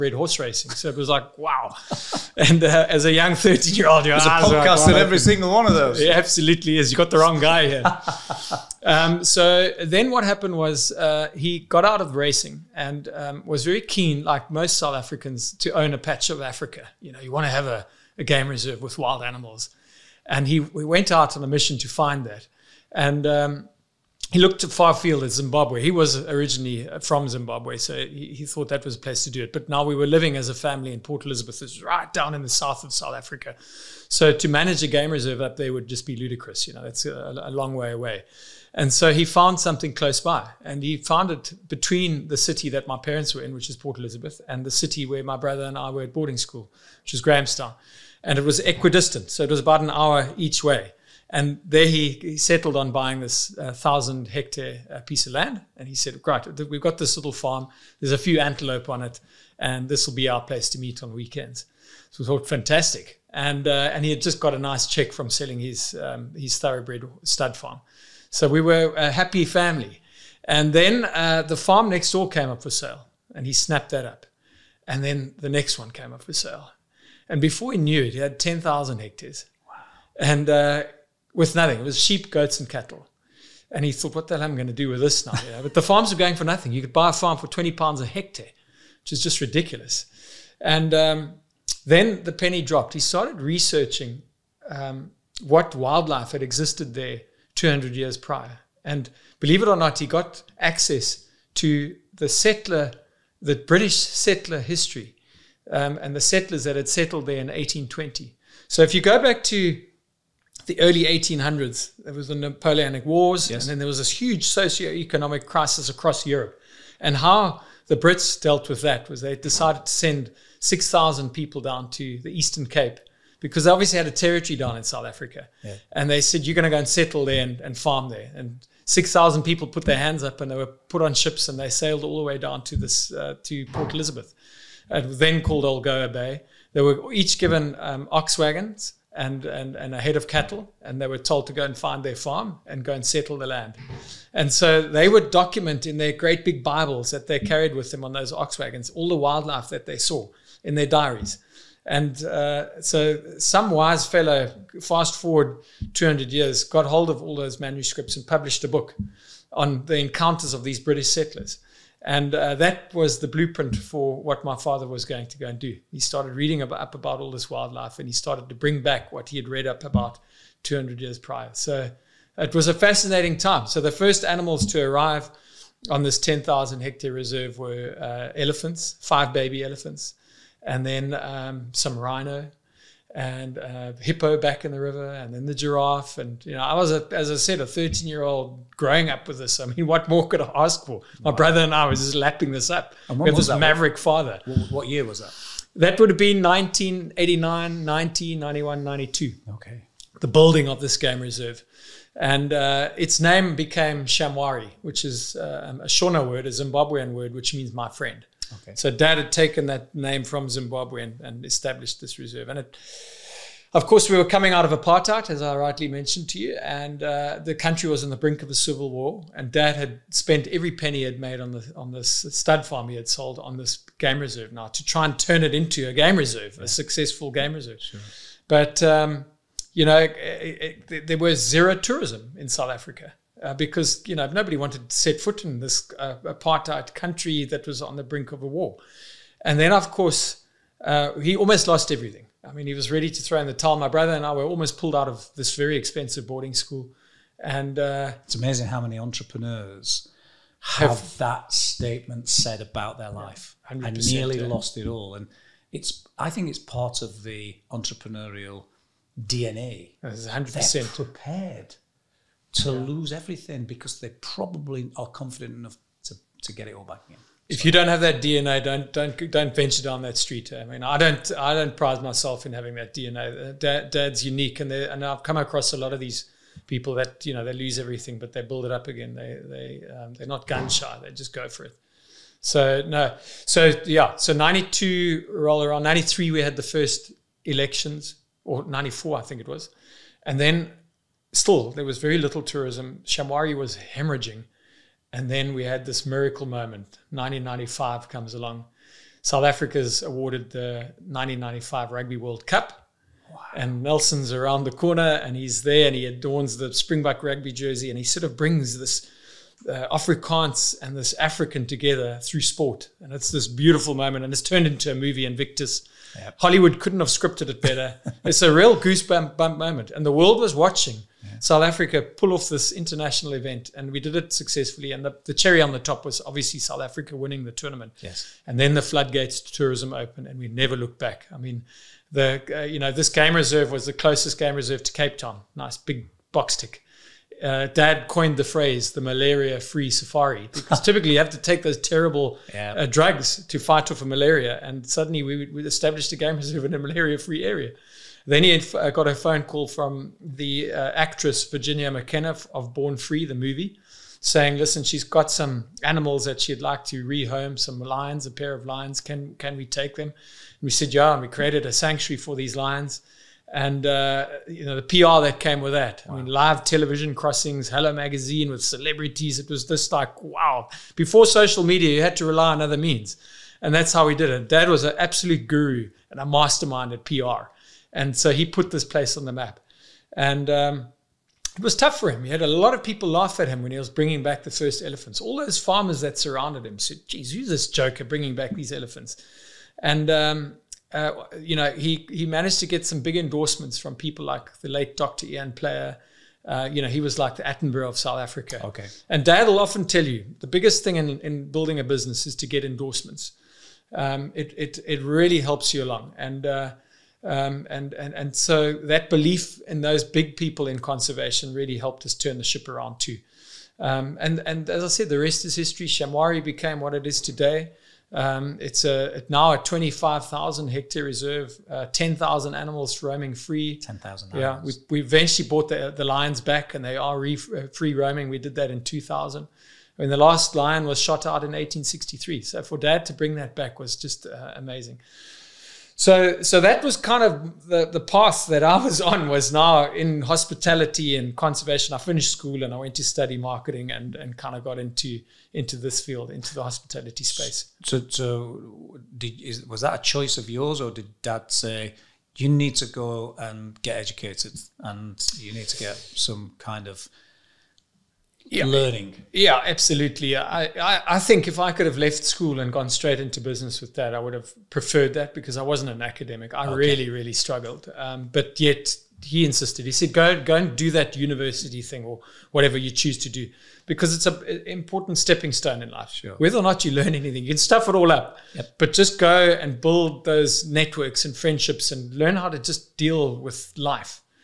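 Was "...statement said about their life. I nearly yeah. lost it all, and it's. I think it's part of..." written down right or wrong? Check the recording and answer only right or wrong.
right.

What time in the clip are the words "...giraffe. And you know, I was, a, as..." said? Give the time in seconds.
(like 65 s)
185 s.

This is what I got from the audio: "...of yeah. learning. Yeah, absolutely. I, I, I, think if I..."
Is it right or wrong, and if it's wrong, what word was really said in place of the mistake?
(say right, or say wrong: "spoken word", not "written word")
right.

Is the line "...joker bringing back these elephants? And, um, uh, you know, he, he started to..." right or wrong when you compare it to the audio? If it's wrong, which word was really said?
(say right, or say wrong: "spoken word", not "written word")
wrong: "managed", not "started".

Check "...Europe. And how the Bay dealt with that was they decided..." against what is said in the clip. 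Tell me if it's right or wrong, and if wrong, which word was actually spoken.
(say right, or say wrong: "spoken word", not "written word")
wrong: "Brits", not "Bay".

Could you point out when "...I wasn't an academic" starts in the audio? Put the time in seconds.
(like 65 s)
465 s.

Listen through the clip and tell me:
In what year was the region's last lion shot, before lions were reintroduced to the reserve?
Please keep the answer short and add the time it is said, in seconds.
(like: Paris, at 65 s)
1863, at 431 s.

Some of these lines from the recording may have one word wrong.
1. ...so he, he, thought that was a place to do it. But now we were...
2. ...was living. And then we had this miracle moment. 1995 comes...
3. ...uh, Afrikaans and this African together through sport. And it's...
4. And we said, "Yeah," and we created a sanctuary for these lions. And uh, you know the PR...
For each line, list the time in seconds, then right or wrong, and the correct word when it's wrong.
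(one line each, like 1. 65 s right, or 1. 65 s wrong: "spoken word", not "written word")
1. 27 s right
2. 293 s wrong: "hemorrhaging", not "living"
3. 309 s right
4. 360 s right.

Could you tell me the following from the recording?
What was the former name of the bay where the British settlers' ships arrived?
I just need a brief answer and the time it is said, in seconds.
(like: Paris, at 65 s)
Algoa Bay, at 135 s.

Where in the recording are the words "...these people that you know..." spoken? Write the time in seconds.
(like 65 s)
275 s.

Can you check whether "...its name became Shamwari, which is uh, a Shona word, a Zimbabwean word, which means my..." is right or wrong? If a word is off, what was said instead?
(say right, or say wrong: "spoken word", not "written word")
right.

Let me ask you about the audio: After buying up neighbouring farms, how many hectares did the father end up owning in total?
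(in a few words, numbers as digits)
10,000 hectares.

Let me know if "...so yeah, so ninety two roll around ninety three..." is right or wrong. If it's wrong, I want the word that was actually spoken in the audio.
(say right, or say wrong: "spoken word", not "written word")
right.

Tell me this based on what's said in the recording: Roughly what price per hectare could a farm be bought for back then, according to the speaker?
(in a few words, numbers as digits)
20 pounds.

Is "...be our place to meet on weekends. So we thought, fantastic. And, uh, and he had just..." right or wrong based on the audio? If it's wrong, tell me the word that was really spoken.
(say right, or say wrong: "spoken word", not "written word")
right.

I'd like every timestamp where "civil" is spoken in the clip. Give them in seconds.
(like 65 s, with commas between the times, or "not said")
218 s.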